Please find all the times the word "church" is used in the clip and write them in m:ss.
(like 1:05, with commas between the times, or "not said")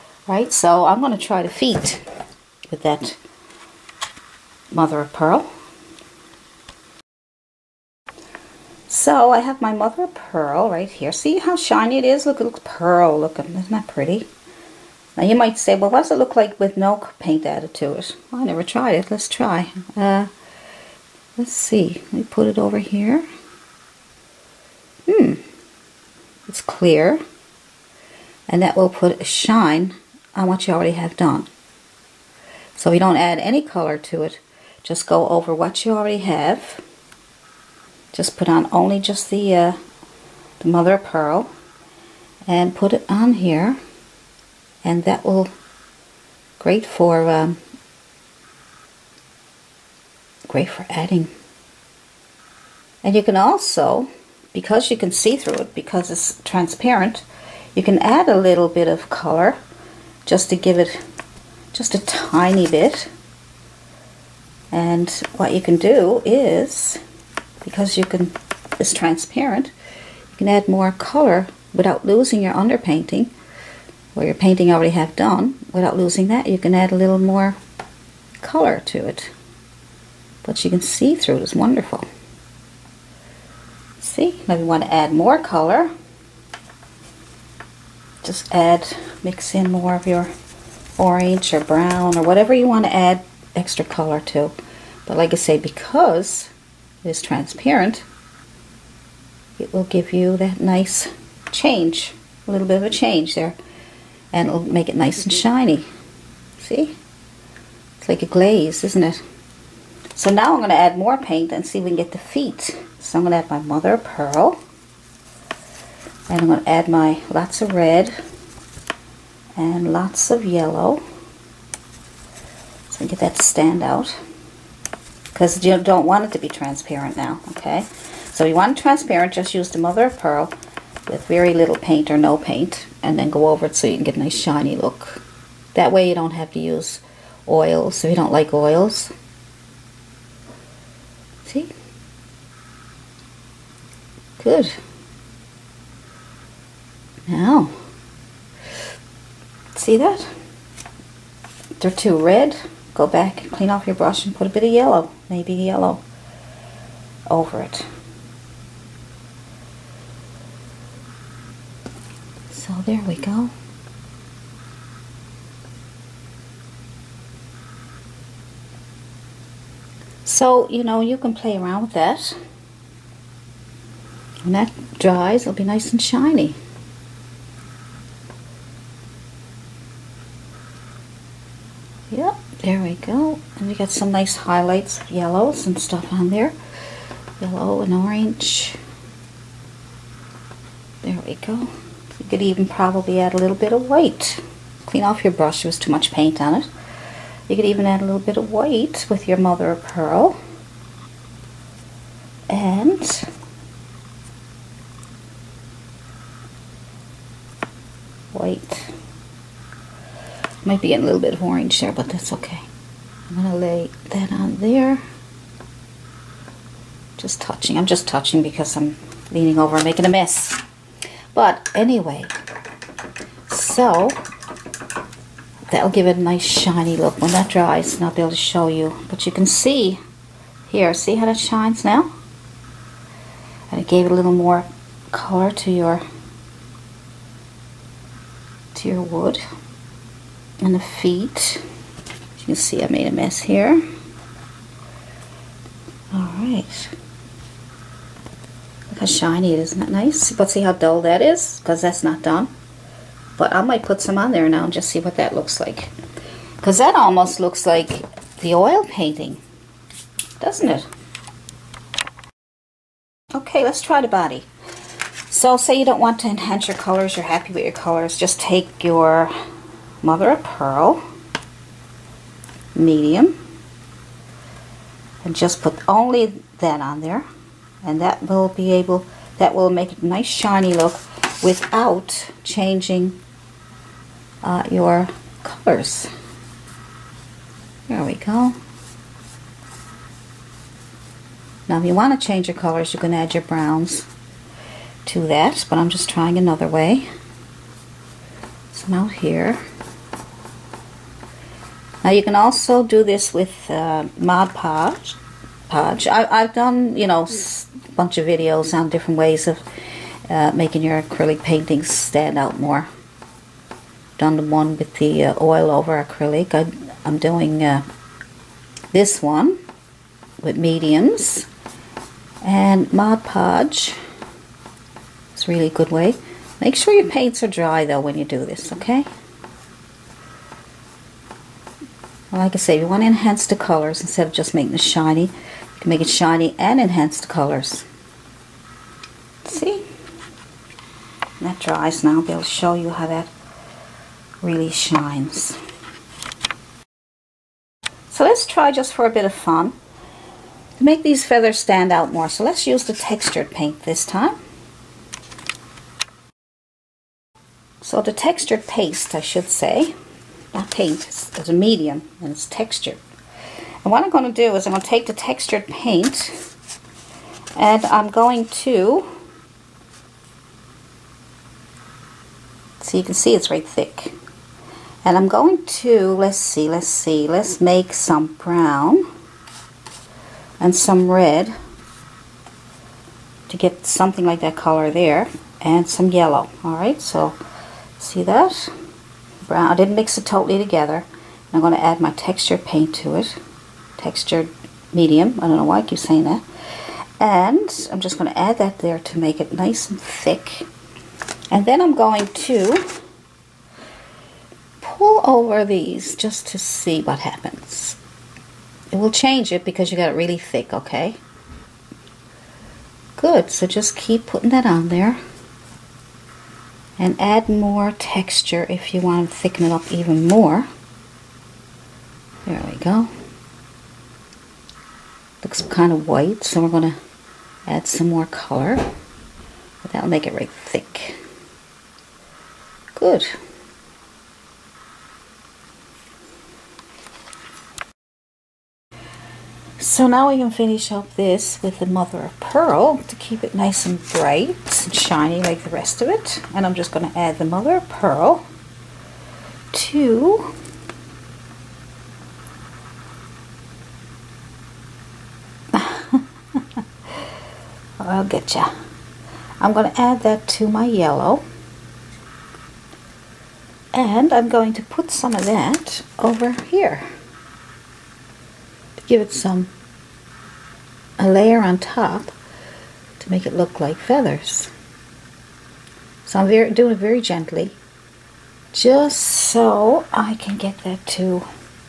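not said.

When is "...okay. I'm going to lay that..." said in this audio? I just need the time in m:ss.
3:32.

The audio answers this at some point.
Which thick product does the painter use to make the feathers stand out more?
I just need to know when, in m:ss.
5:58.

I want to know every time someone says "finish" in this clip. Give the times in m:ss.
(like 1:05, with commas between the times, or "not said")
7:20.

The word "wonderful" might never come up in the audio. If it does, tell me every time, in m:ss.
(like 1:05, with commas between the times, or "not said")
1:21.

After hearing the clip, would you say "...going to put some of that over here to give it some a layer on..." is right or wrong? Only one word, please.
right.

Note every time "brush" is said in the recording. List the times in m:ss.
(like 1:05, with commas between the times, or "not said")
2:33, 3:15.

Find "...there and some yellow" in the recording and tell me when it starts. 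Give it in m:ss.
6:24.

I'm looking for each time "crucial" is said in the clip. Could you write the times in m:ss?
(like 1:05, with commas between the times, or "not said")
not said.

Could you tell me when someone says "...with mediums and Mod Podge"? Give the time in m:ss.
5:20.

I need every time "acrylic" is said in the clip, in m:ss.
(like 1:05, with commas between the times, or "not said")
5:11, 5:16.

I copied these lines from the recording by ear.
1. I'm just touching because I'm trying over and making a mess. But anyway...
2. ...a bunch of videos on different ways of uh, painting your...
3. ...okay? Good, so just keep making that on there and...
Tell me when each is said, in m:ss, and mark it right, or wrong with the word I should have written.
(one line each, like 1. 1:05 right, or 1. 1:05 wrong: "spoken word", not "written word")
1. 3:37 wrong: "leaning", not "trying"
2. 5:07 wrong: "making", not "painting"
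3. 6:50 wrong: "putting", not "making".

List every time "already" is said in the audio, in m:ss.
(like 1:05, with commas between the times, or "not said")
0:30, 0:35, 1:14.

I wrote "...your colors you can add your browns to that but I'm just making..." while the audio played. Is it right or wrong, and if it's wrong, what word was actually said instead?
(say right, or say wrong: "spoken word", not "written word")
wrong: "trying", not "making".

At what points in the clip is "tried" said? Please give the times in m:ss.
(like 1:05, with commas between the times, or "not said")
0:18.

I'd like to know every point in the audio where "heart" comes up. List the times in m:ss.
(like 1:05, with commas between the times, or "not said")
not said.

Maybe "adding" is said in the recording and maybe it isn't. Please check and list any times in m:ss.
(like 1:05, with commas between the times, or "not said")
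0:50.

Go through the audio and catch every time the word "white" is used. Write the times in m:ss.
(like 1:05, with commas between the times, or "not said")
3:13, 3:18, 7:06.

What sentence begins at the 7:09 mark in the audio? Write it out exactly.
But that'll make it right thick.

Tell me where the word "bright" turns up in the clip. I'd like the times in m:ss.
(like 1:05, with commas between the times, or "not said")
7:24.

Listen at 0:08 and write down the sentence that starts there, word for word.
So I have my mother of pearl right here.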